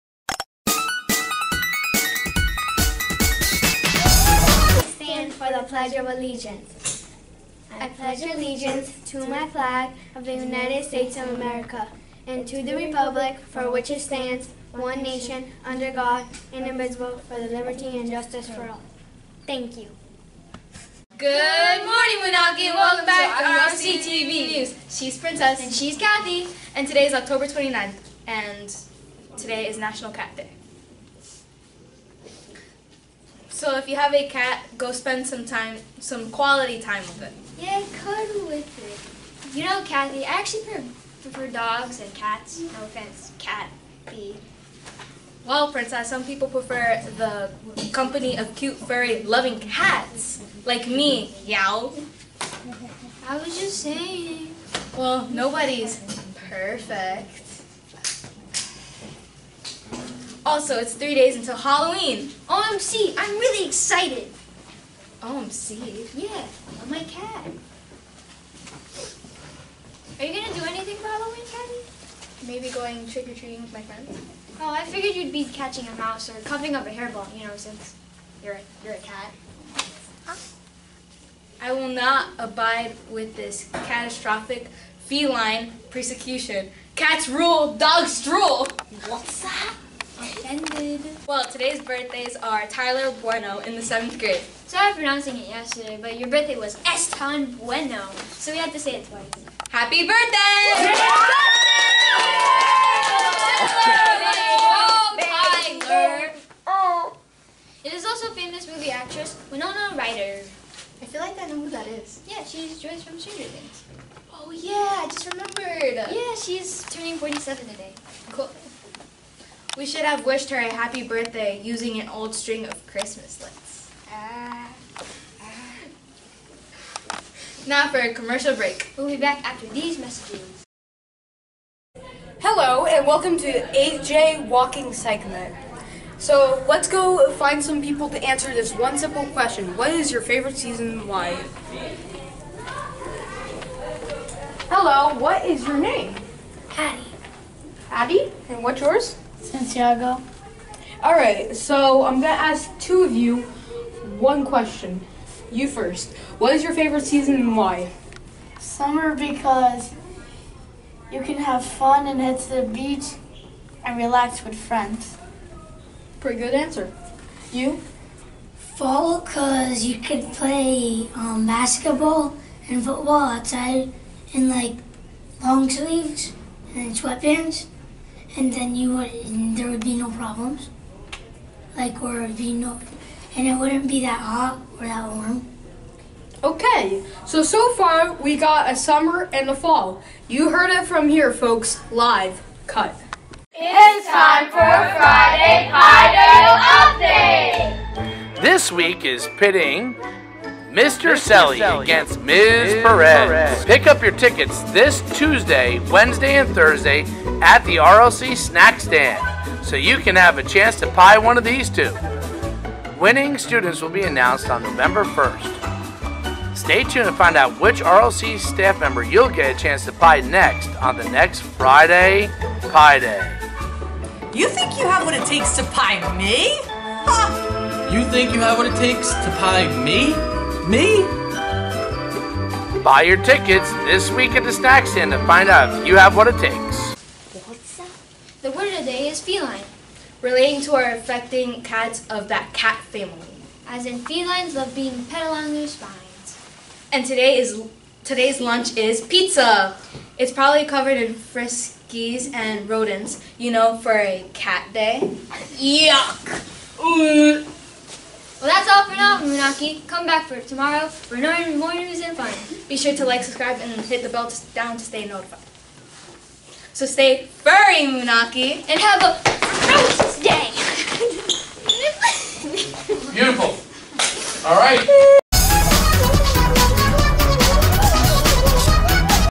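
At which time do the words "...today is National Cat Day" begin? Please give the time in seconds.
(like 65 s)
29 s.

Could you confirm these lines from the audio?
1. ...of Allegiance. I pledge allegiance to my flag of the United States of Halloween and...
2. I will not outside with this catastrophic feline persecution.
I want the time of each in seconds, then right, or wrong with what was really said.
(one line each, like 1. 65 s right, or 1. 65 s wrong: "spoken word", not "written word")
1. 5 s wrong: "America", not "Halloween"
2. 81 s wrong: "abide", not "outside".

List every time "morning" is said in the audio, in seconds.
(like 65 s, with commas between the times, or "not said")
21 s.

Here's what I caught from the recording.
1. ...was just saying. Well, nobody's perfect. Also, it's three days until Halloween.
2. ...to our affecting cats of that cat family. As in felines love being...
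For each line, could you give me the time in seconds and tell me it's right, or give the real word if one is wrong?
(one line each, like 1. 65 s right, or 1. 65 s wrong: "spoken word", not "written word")
1. 53 s right
2. 240 s right.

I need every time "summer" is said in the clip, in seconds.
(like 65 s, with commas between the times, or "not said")
158 s, 188 s.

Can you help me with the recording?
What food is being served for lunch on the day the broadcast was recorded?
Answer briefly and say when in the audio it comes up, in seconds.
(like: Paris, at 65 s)
Pizza, at 249 s.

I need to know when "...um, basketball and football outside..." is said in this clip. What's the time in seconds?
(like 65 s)
171 s.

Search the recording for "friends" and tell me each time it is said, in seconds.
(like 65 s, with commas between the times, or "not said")
73 s, 164 s.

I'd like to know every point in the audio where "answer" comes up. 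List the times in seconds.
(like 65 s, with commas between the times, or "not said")
138 s, 166 s.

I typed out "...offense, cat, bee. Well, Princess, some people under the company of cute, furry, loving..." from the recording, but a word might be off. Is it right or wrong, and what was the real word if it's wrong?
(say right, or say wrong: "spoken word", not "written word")
wrong: "prefer", not "under".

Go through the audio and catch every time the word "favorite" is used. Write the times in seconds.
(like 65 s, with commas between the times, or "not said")
140 s, 156 s.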